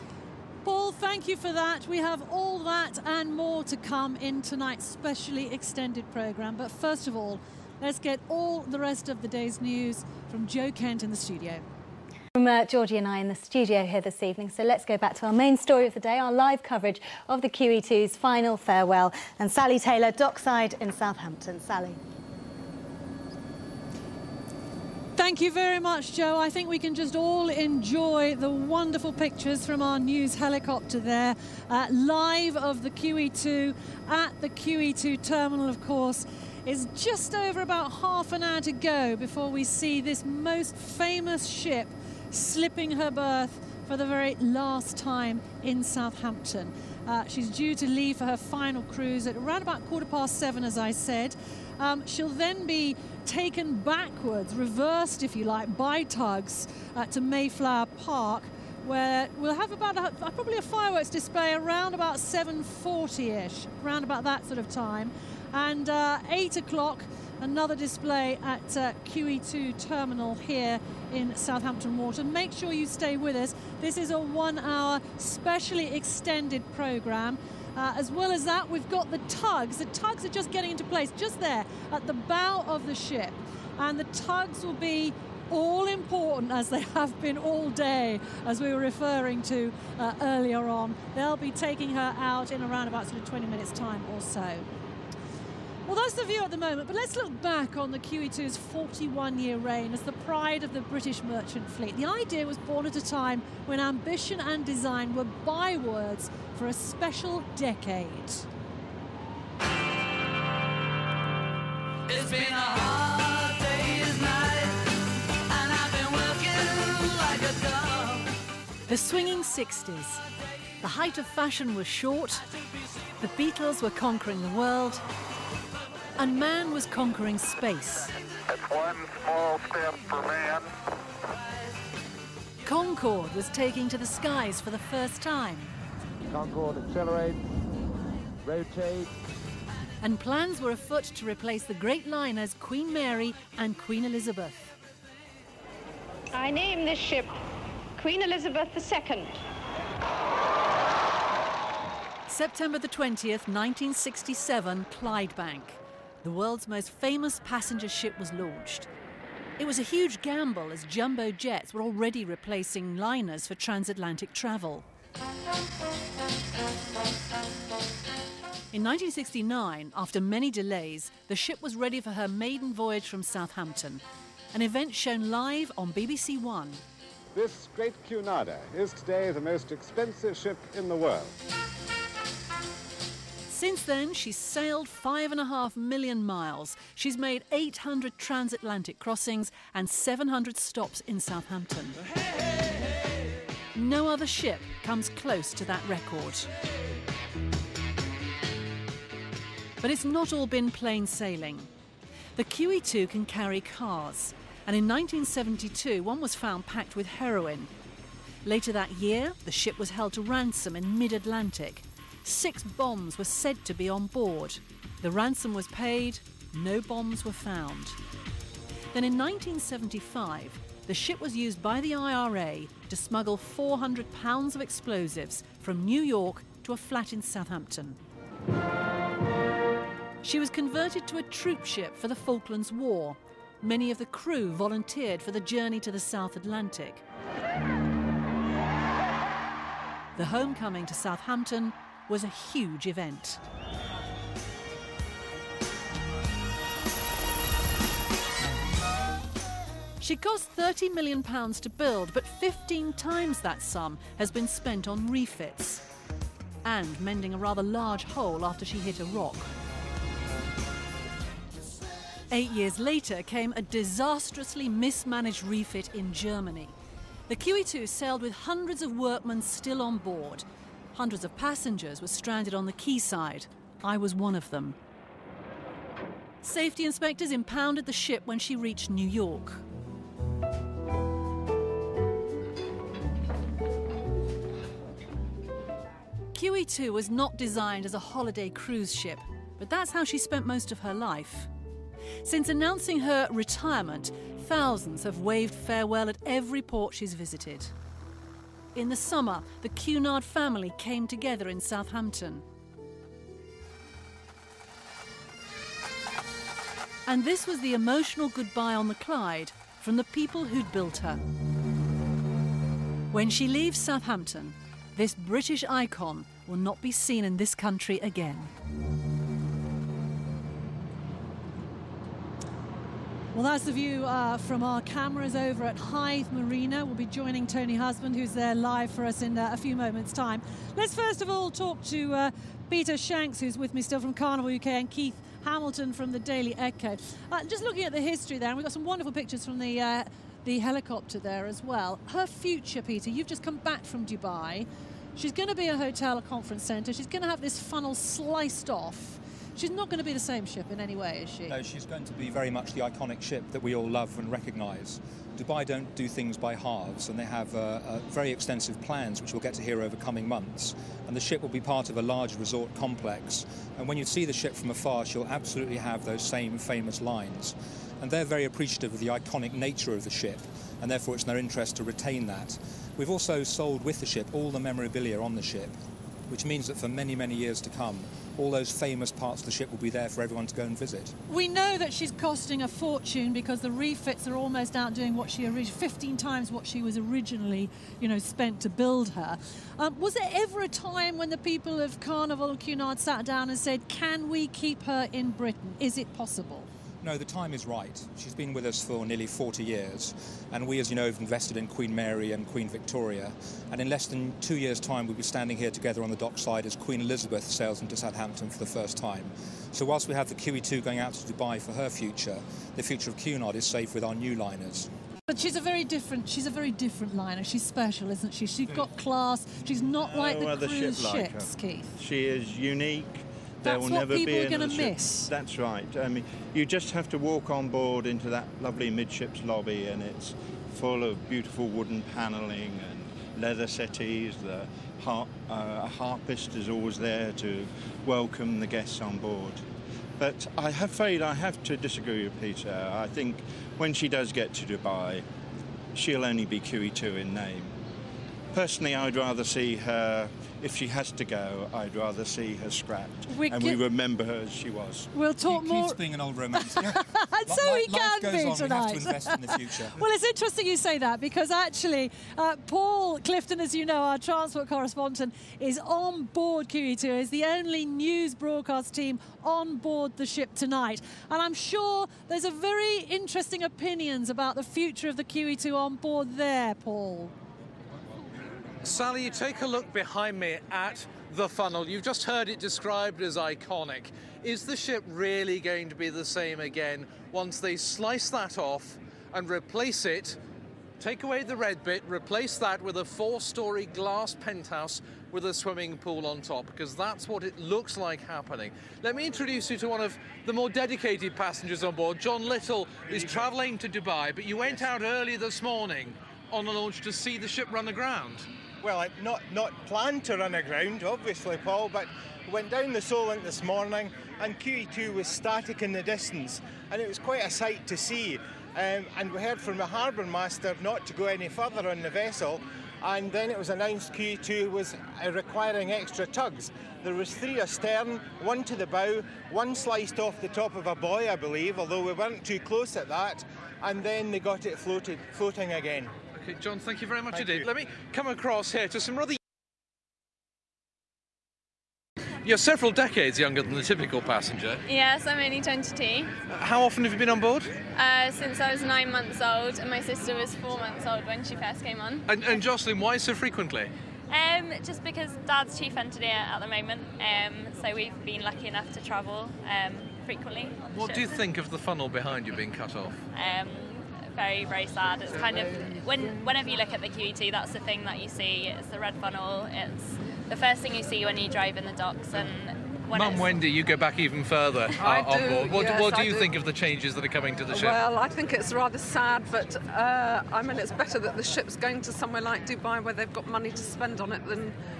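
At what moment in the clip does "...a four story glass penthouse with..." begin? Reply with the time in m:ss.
8:12.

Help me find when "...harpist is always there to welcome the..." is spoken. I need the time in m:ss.
7:15.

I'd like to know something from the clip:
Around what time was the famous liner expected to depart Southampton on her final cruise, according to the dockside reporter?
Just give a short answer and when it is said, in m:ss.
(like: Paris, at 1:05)
quarter past seven, at 0:49.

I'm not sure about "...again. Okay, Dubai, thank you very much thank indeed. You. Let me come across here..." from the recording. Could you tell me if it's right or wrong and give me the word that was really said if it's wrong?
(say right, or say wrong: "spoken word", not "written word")
wrong: "John", not "Dubai".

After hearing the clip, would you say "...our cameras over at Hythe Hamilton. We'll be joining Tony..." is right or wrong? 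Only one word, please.
wrong.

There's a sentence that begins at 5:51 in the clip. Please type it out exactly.
No, she's going to be very much the iconic ship that we all love and recognise.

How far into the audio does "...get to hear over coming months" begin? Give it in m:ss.
5:59.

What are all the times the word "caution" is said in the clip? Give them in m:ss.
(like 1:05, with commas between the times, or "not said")
not said.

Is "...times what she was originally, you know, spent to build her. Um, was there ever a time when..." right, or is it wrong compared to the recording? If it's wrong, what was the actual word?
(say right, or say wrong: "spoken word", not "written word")
right.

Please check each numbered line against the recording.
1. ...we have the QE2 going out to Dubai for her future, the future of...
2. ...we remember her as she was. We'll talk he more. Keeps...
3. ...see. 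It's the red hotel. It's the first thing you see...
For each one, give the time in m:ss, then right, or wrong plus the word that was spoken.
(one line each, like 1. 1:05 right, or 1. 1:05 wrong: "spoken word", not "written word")
1. 6:50 right
2. 7:33 right
3. 9:28 wrong: "funnel", not "hotel".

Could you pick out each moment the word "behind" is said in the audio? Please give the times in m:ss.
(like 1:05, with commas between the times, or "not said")
7:59, 9:22.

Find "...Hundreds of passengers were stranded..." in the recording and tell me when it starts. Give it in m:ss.
4:30.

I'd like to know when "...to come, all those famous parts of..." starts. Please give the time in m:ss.
6:17.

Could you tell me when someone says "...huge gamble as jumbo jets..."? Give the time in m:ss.
2:39.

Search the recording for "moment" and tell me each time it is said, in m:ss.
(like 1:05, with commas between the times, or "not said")
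1:36, 5:29, 9:16.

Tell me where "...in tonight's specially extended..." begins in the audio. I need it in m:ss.
0:04.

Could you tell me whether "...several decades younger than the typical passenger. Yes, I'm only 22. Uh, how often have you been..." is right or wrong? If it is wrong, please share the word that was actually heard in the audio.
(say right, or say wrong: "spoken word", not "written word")
right.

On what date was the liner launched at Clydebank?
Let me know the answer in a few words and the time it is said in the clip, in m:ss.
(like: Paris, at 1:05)
September 20th, 1967, at 2:32.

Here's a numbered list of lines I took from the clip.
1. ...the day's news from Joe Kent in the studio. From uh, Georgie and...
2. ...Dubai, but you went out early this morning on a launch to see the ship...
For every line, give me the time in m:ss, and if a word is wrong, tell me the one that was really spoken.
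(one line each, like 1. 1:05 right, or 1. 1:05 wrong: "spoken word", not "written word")
1. 0:09 right
2. 8:23 right.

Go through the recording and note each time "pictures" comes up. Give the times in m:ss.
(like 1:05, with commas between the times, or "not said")
0:29, 5:39.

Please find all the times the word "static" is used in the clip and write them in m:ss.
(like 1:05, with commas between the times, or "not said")
8:35.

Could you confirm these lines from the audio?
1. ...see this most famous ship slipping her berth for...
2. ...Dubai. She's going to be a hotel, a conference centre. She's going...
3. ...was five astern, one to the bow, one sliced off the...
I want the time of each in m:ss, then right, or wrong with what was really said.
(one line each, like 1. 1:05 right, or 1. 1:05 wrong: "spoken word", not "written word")
1. 0:39 right
2. 5:44 right
3. 8:47 wrong: "three", not "five".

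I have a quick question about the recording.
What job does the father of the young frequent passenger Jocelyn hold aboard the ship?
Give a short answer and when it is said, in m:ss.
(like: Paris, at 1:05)
chief engineer, at 9:15.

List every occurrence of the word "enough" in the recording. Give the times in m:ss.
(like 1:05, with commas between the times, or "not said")
9:18.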